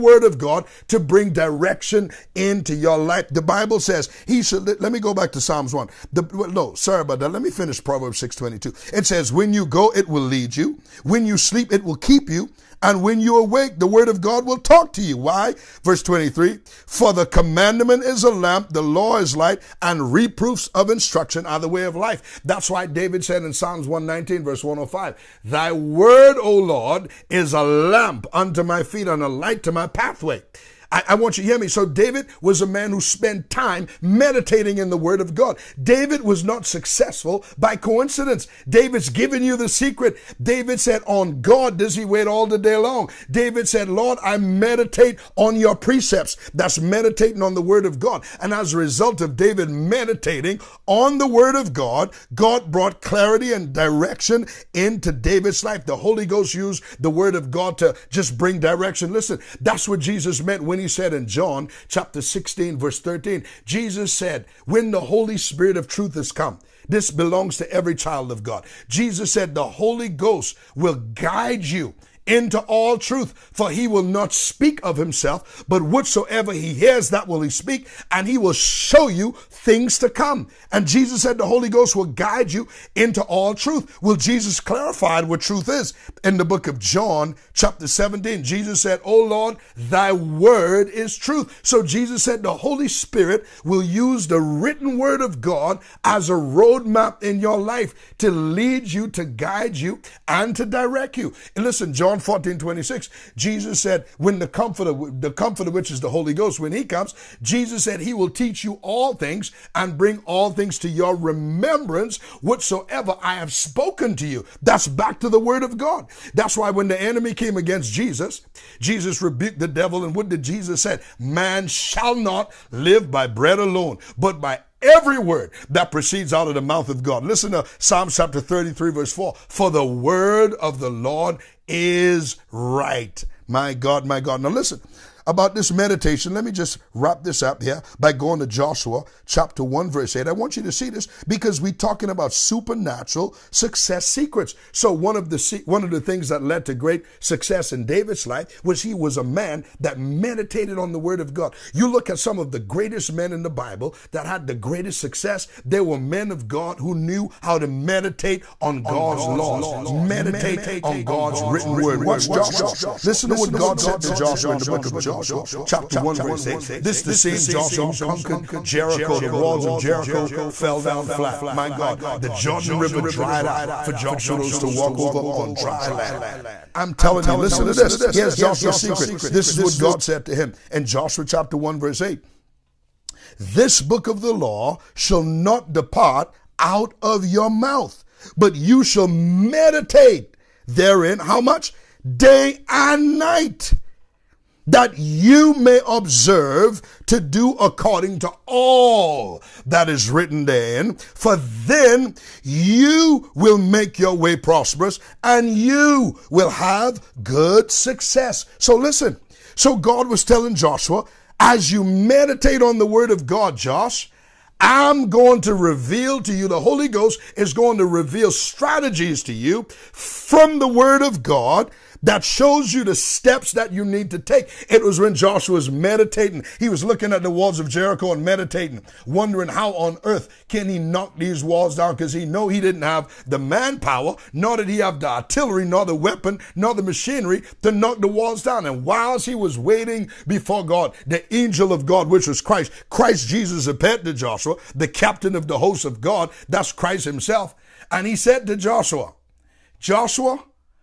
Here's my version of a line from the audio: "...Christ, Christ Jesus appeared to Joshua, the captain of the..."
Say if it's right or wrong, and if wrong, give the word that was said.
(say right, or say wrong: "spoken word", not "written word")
right.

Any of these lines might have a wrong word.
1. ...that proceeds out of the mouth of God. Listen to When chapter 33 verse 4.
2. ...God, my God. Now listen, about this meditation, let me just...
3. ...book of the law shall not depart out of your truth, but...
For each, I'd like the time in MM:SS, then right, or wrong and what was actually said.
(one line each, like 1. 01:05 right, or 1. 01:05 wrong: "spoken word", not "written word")
1. 02:05 wrong: "Psalm", not "When"
2. 02:13 right
3. 03:03 wrong: "mouth", not "truth".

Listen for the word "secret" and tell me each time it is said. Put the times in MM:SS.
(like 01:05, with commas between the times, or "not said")
00:39, 02:24, 02:58.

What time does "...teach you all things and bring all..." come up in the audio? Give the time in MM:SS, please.
01:48.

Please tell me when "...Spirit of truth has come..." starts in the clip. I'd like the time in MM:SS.
01:05.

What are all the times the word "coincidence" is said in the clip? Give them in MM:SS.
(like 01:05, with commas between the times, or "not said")
00:37.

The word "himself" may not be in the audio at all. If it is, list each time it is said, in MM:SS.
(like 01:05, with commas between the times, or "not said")
01:14, 04:07.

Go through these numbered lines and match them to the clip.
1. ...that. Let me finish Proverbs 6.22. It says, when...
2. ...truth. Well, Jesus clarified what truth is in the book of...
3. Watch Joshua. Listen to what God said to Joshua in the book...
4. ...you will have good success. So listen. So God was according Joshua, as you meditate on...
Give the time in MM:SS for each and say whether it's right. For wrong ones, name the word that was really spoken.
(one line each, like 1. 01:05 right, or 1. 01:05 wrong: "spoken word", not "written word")
1. 00:07 right
2. 01:23 right
3. 02:41 right
4. 03:25 wrong: "telling", not "according".